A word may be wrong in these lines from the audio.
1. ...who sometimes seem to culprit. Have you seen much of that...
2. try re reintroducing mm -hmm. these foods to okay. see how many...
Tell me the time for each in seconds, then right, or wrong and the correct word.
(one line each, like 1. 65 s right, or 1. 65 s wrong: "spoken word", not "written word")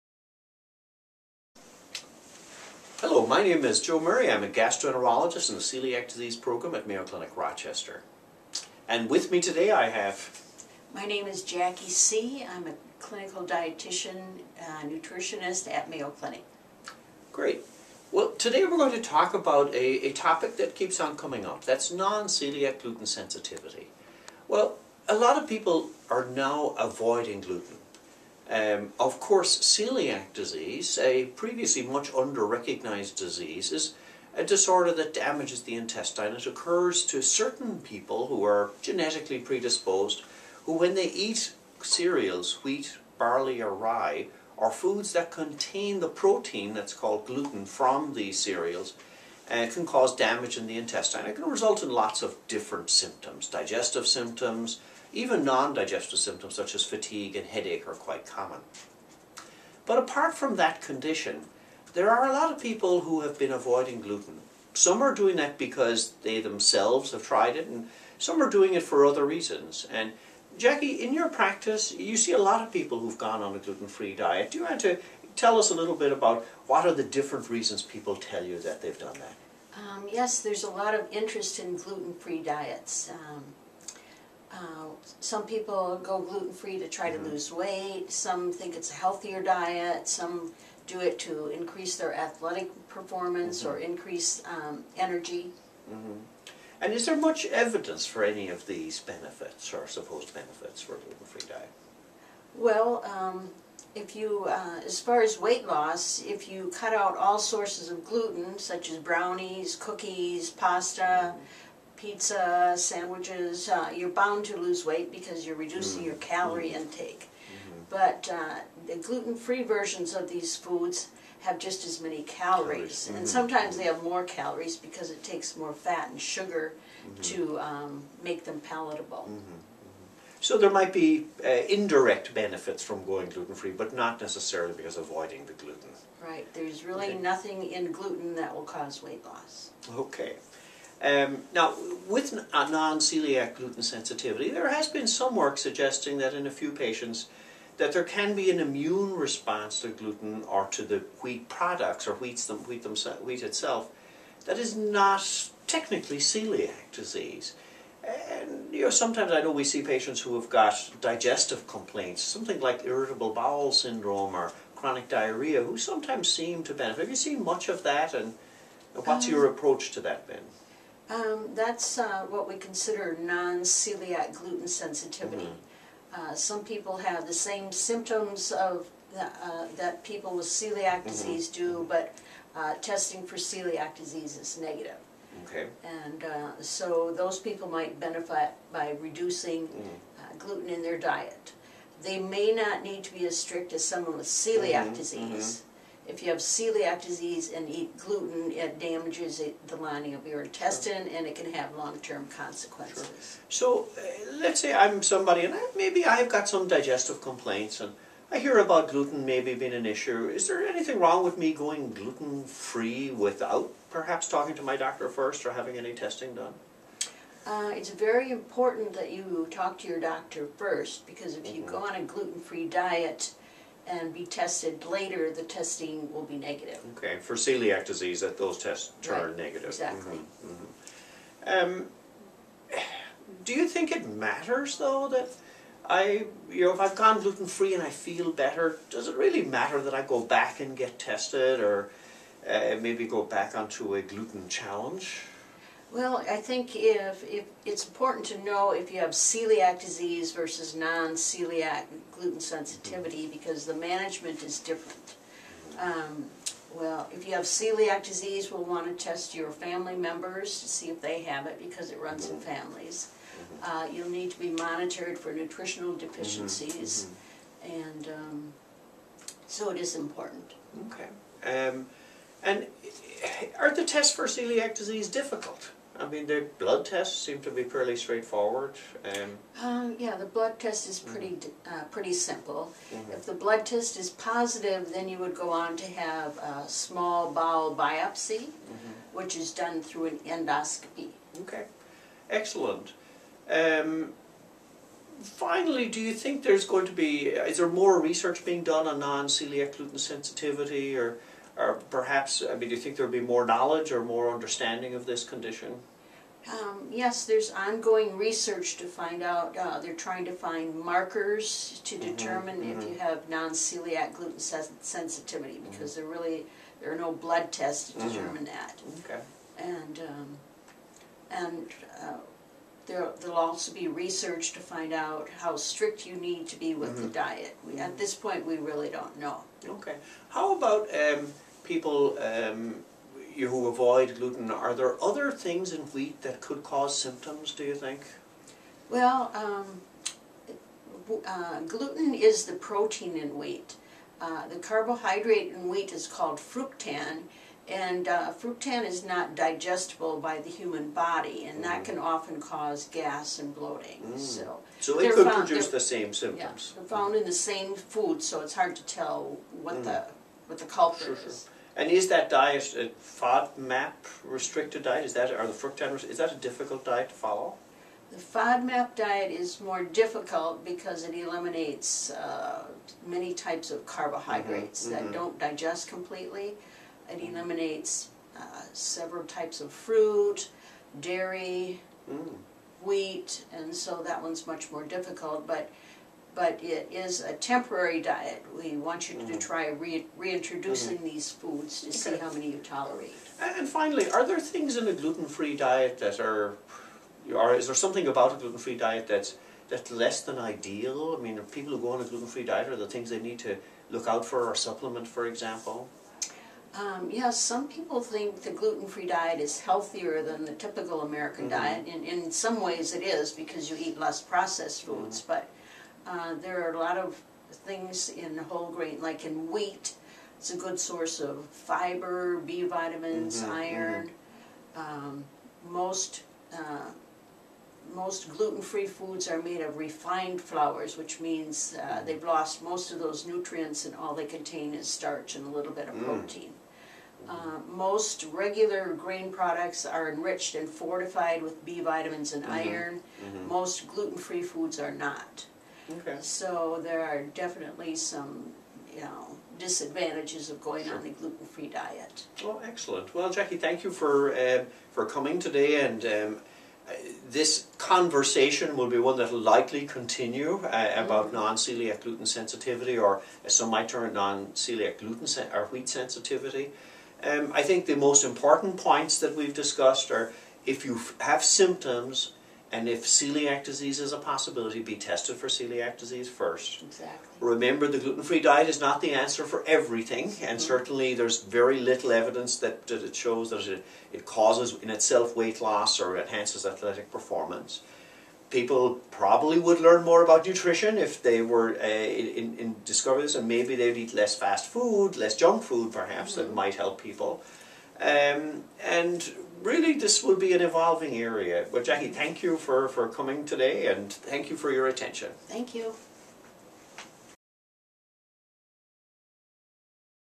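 1. 165 s wrong: "benefit", not "culprit"
2. 389 s right.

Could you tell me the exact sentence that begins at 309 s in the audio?
Uh, they're trying to find markers to mm-hmm, determine mm -hmm.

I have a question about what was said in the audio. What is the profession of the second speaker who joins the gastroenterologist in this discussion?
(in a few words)
Clinical dietitian.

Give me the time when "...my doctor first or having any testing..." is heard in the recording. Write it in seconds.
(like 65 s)
214 s.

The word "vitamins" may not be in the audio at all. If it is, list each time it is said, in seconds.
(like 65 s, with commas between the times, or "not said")
422 s, 441 s.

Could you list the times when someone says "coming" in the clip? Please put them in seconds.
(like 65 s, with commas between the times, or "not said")
21 s, 455 s, 503 s.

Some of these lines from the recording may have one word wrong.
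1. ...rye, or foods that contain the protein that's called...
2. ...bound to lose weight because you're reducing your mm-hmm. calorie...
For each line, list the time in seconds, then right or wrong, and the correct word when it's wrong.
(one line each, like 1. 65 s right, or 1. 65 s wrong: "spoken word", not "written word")
1. 43 s right
2. 114 s right.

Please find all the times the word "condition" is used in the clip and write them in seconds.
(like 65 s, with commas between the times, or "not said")
60 s, 305 s.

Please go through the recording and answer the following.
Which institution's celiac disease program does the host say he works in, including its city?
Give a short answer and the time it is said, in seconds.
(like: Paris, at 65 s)
Mayo Clinic Rochester, at 6 s.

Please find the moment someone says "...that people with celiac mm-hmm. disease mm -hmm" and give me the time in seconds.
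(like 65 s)
179 s.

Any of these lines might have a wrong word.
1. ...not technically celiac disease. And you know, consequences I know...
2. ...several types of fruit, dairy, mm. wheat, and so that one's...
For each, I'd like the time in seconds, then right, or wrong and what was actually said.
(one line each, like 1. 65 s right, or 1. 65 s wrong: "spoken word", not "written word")
1. 154 s wrong: "sometimes", not "consequences"
2. 378 s right.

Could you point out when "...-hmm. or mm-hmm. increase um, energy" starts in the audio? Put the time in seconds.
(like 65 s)
93 s.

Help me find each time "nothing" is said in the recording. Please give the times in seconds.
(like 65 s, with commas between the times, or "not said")
137 s.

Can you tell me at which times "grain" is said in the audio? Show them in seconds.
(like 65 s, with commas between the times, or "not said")
418 s, 438 s.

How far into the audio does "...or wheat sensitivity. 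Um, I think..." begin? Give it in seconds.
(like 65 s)
465 s.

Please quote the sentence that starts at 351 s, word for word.
can often cause gas and bloating.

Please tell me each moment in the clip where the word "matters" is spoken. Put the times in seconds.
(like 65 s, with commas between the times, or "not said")
234 s, 239 s.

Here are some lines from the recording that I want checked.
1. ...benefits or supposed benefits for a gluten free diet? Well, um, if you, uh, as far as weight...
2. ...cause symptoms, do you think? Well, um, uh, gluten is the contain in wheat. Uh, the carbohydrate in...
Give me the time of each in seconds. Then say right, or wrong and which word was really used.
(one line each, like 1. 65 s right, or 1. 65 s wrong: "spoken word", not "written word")
1. 99 s right
2. 336 s wrong: "protein", not "contain".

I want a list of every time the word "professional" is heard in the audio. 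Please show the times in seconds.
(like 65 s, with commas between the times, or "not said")
not said.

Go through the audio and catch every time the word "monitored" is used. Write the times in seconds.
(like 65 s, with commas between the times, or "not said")
264 s.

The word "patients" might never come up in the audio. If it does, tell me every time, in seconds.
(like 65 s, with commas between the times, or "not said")
146 s, 159 s.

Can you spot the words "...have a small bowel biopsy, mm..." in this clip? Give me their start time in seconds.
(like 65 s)
285 s.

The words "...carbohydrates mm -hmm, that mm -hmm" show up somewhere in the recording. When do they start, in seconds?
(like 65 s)
373 s.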